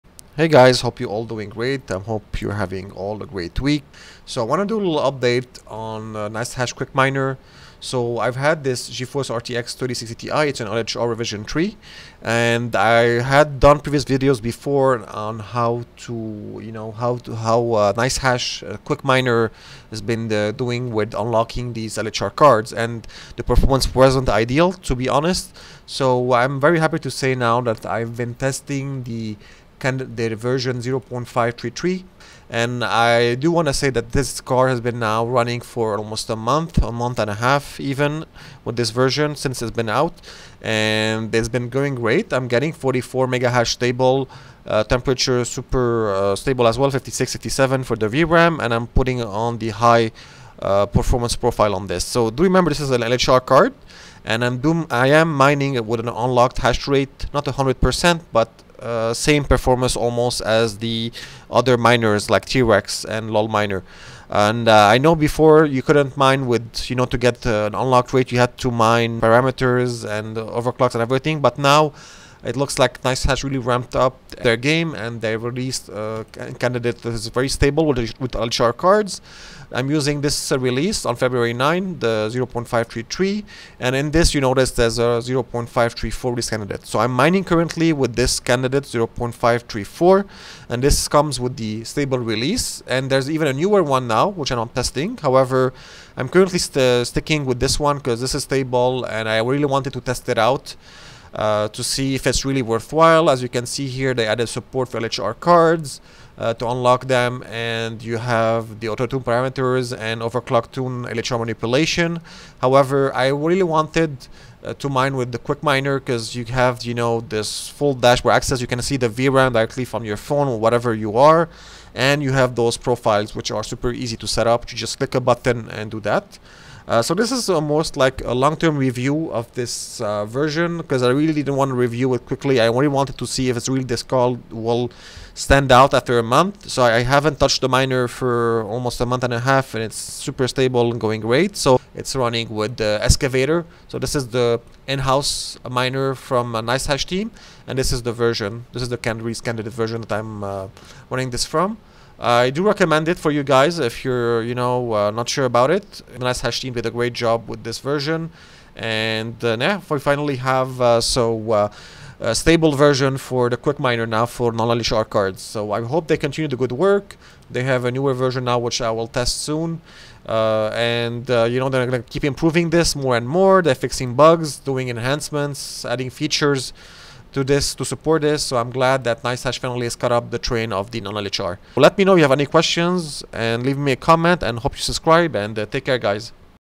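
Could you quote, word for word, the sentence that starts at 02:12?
I only wanted to see if it's really this call will stand out after a month.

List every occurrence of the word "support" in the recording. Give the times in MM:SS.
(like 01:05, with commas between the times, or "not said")
01:44, 02:57.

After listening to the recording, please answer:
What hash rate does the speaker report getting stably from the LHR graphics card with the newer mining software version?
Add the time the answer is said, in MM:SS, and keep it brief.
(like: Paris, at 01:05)
44, at 00:42.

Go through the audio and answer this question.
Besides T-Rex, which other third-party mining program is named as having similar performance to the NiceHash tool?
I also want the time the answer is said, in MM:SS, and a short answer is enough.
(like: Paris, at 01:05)
lolMiner, at 01:03.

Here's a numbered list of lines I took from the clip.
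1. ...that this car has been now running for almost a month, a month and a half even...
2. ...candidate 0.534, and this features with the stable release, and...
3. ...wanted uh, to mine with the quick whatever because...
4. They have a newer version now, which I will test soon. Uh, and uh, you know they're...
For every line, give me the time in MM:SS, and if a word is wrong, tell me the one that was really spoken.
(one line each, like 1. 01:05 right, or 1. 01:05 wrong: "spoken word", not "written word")
1. 00:33 right
2. 01:28 wrong: "comes", not "features"
3. 01:53 wrong: "miner", not "whatever"
4. 02:47 right.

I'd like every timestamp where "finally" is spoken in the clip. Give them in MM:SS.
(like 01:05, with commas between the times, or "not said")
02:39, 02:59.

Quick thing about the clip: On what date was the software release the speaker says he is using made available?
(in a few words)
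February 9.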